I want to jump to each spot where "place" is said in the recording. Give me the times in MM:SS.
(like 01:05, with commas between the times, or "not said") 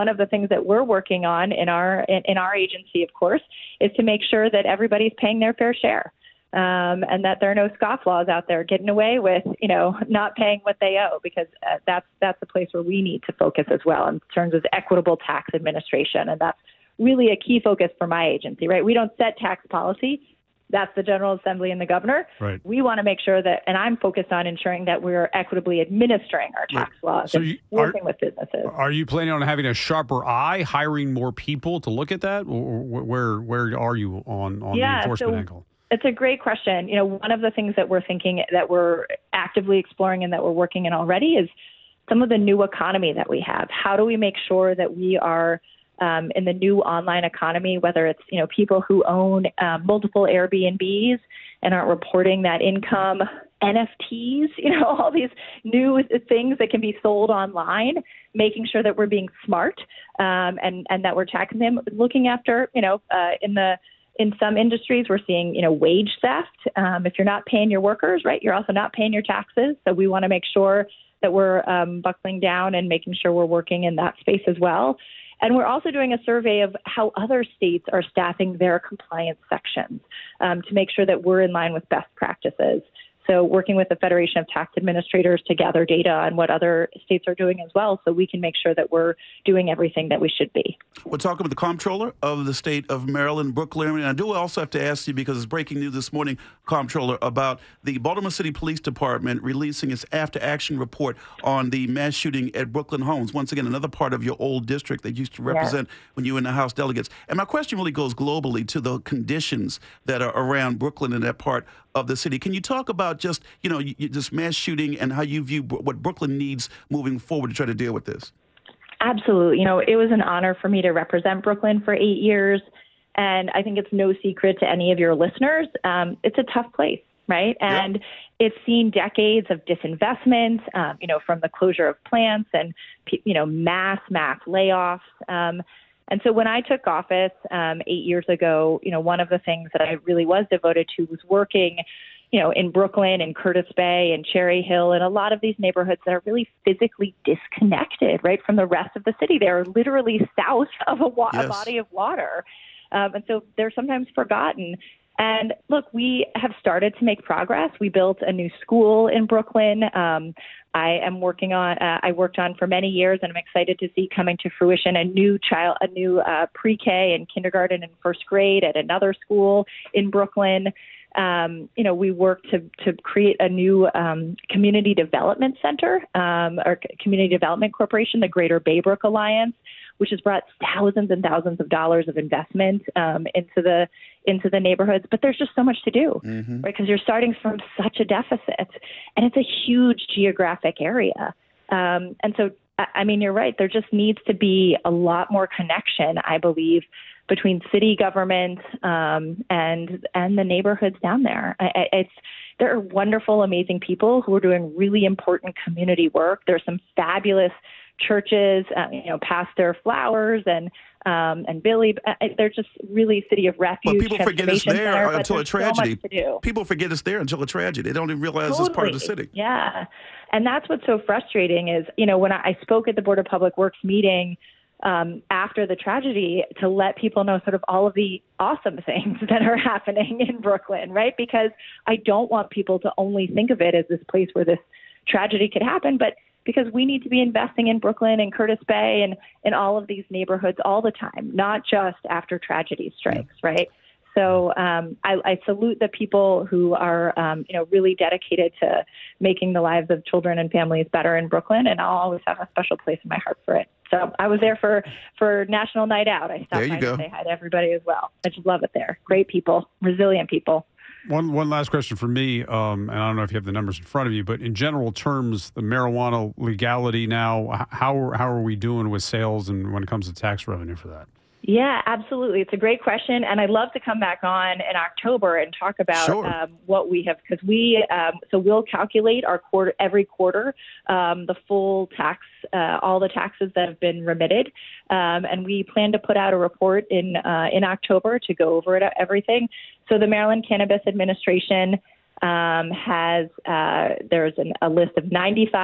00:12, 02:06, 03:54, 04:12.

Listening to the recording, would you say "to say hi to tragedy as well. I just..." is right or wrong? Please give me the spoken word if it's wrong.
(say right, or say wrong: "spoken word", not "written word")
wrong: "everybody", not "tragedy".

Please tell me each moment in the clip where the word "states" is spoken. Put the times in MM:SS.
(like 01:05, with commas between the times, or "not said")
01:17, 01:27, 01:32.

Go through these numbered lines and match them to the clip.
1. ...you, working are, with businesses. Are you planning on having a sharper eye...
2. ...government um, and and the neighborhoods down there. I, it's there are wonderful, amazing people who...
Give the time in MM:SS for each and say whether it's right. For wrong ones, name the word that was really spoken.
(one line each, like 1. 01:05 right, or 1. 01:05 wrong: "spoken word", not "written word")
1. 00:27 right
2. 03:17 right.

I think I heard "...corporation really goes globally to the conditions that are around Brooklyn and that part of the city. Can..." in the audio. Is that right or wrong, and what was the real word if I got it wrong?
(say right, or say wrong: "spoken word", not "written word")
wrong: "question", not "corporation".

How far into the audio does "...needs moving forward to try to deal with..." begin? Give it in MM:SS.
01:56.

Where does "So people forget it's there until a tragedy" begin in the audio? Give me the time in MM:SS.
03:36.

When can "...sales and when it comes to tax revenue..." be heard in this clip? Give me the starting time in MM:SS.
04:29.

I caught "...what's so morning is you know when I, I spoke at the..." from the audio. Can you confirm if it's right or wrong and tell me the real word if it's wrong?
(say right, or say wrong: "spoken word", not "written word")
wrong: "frustrating", not "morning".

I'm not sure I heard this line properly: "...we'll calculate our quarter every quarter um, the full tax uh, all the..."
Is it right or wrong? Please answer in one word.
right.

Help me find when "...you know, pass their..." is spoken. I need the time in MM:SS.
03:28.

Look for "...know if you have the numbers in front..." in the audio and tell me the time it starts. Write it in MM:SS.
04:23.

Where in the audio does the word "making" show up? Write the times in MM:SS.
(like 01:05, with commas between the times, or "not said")
00:58, 01:12, 04:09.